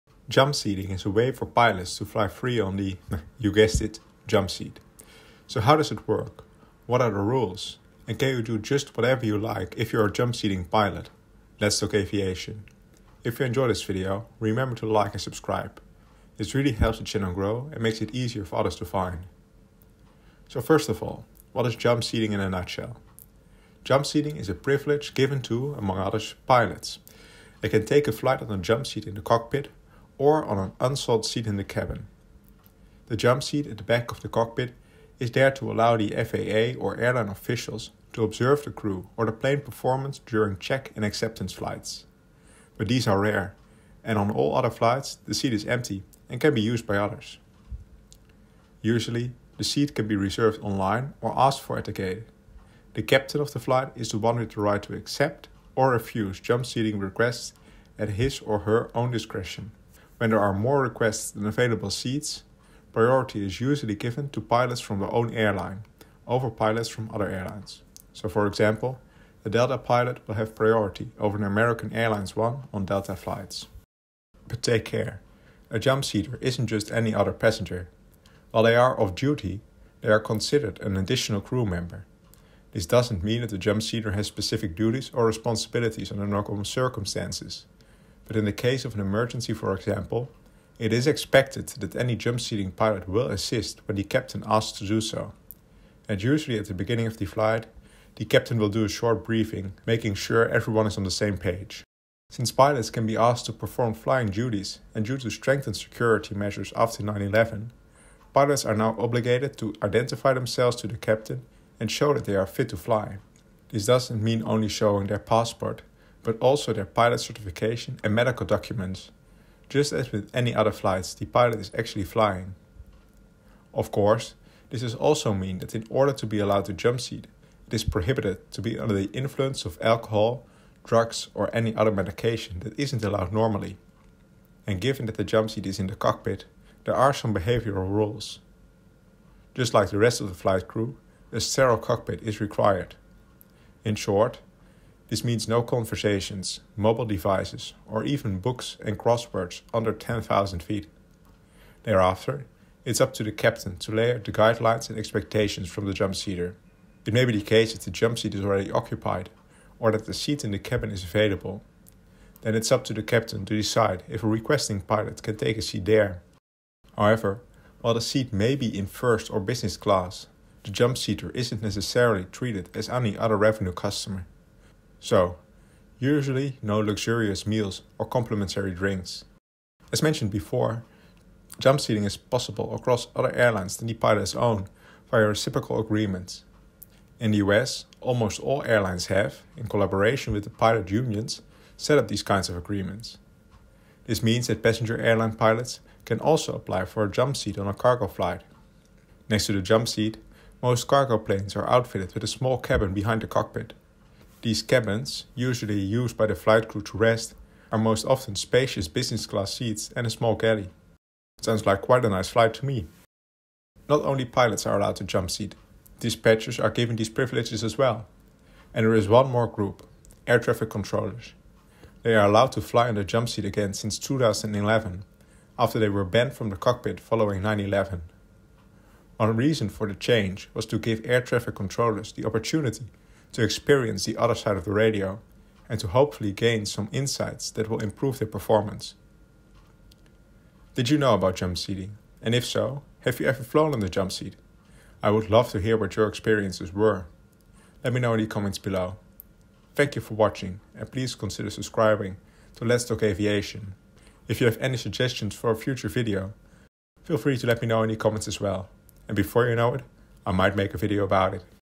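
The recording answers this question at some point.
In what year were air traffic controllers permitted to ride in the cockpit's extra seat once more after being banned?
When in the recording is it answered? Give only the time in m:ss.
3:43.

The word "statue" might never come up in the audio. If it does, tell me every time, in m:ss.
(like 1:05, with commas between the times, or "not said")
not said.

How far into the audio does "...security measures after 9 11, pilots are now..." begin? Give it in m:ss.
1:45.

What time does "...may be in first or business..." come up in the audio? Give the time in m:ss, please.
2:48.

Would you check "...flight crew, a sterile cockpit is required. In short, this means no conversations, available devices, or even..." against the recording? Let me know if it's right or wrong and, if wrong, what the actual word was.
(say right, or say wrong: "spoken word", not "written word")
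wrong: "mobile", not "available".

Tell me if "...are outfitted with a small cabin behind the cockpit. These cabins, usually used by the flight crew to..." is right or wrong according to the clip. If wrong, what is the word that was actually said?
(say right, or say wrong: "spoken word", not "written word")
right.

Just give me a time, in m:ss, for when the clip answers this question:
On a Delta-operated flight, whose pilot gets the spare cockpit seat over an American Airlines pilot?
1:09.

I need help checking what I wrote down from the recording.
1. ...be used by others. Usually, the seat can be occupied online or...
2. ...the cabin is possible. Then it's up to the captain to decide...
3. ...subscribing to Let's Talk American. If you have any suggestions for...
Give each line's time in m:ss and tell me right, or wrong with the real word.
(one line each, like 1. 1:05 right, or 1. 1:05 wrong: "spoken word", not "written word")
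1. 0:46 wrong: "reserved", not "occupied"
2. 2:40 wrong: "available", not "possible"
3. 4:11 wrong: "Aviation", not "American".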